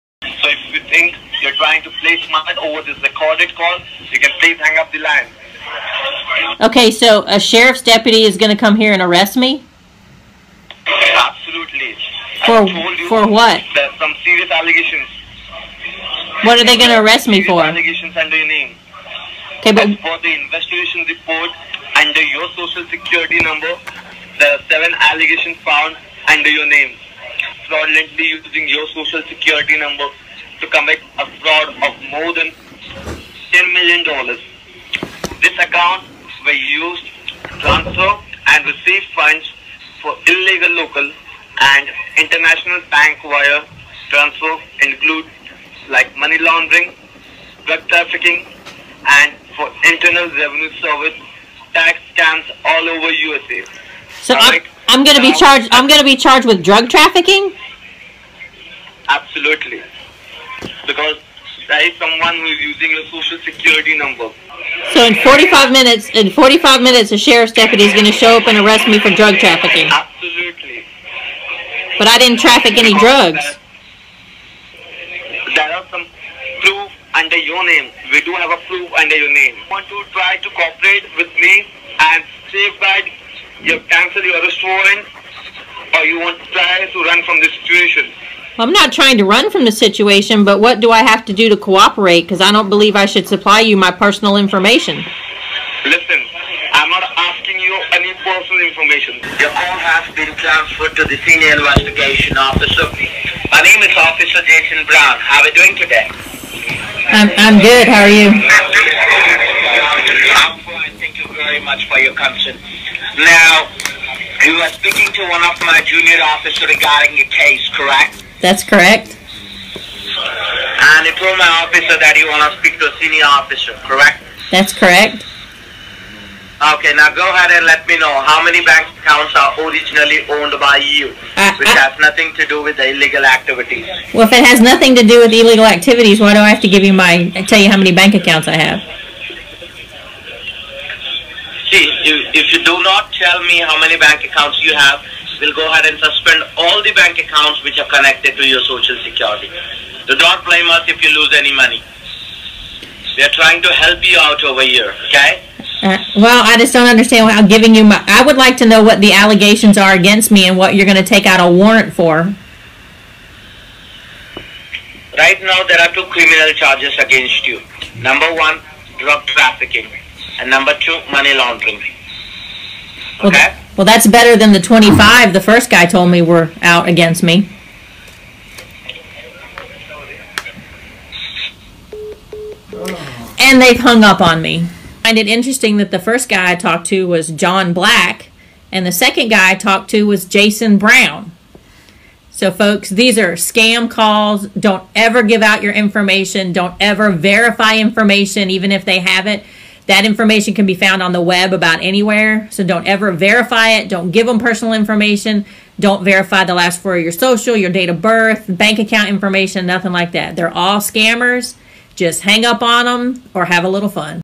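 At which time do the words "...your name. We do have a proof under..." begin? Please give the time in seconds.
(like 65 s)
77 s.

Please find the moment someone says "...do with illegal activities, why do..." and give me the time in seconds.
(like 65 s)
135 s.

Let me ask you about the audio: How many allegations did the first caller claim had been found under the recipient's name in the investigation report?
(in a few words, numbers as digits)
7.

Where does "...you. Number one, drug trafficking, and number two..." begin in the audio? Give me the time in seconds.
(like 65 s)
167 s.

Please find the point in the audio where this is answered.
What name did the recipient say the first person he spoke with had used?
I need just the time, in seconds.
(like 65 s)
187 s.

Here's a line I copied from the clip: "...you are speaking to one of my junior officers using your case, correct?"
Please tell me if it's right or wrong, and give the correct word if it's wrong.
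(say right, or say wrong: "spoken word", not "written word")
wrong: "regarding", not "using".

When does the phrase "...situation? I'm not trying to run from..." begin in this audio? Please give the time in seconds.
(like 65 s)
87 s.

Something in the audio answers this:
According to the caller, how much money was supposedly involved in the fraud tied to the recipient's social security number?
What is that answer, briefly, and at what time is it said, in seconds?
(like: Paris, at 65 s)
more than $10 million, at 32 s.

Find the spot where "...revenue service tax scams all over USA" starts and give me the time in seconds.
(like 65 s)
50 s.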